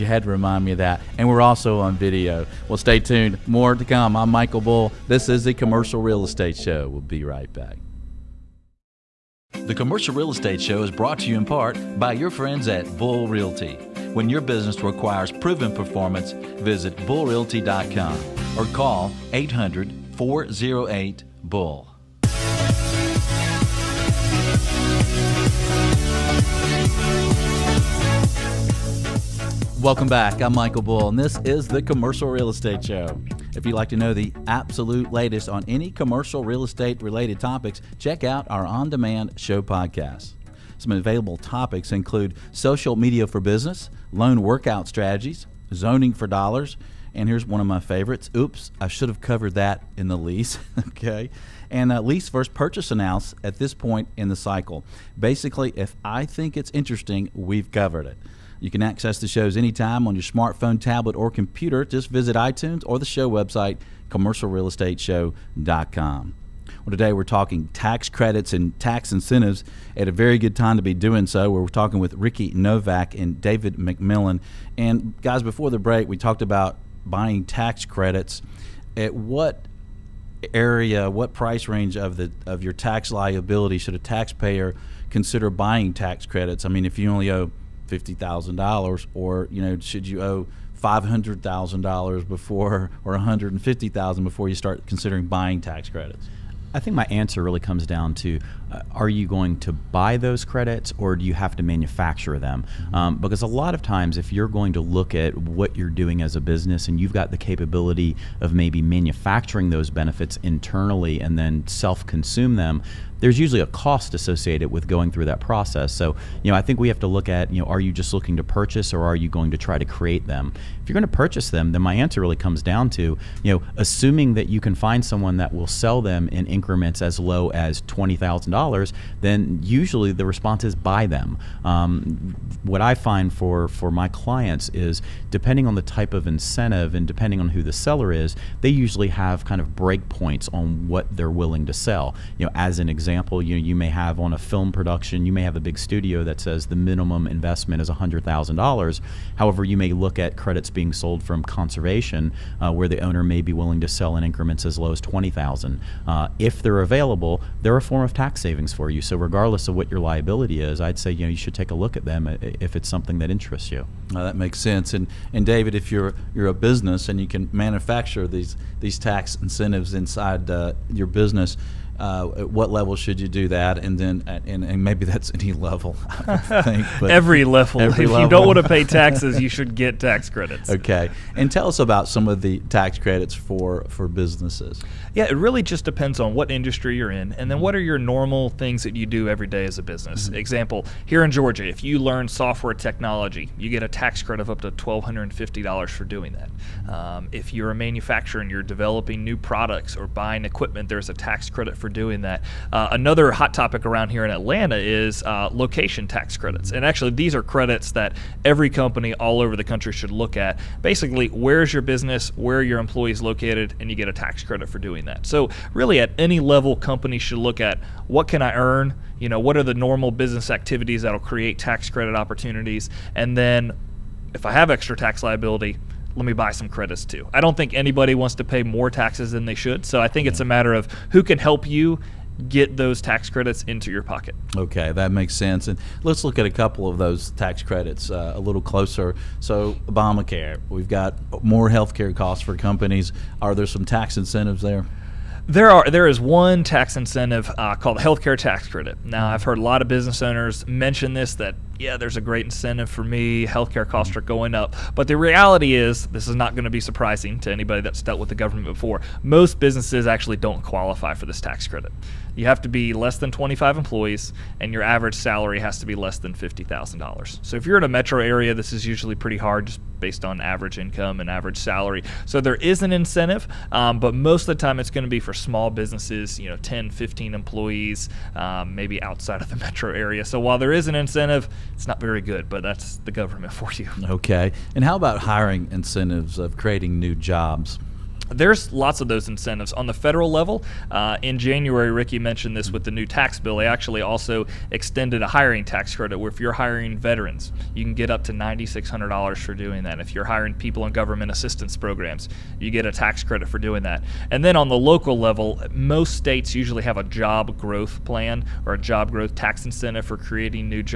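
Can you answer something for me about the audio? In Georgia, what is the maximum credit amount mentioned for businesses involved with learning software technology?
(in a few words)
$1,250.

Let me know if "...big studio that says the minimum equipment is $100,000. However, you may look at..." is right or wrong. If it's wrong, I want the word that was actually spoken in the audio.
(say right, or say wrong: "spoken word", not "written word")
wrong: "investment", not "equipment".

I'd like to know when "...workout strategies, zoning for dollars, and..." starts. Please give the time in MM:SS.
00:44.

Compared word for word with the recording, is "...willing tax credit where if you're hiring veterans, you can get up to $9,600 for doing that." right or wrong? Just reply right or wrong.
wrong.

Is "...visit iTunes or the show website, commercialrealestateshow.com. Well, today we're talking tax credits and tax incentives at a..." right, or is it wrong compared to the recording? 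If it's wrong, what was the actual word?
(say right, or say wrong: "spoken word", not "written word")
right.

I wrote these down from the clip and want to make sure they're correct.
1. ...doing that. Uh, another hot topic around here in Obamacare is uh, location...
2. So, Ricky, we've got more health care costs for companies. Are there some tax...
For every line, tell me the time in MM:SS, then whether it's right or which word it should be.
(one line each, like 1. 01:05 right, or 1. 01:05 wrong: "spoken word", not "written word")
1. 03:21 wrong: "Atlanta", not "Obamacare"
2. 03:59 wrong: "Obamacare", not "Ricky".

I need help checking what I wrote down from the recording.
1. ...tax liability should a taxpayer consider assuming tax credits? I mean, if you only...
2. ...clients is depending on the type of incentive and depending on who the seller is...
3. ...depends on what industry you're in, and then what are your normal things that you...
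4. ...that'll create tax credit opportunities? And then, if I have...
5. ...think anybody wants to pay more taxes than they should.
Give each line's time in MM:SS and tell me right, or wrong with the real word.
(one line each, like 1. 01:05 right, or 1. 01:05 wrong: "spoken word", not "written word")
1. 01:22 wrong: "buying", not "assuming"
2. 02:14 right
3. 03:05 right
4. 03:41 right
5. 03:47 right.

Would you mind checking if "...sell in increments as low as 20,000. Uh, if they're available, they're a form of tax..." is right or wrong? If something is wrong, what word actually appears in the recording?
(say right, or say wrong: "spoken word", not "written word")
right.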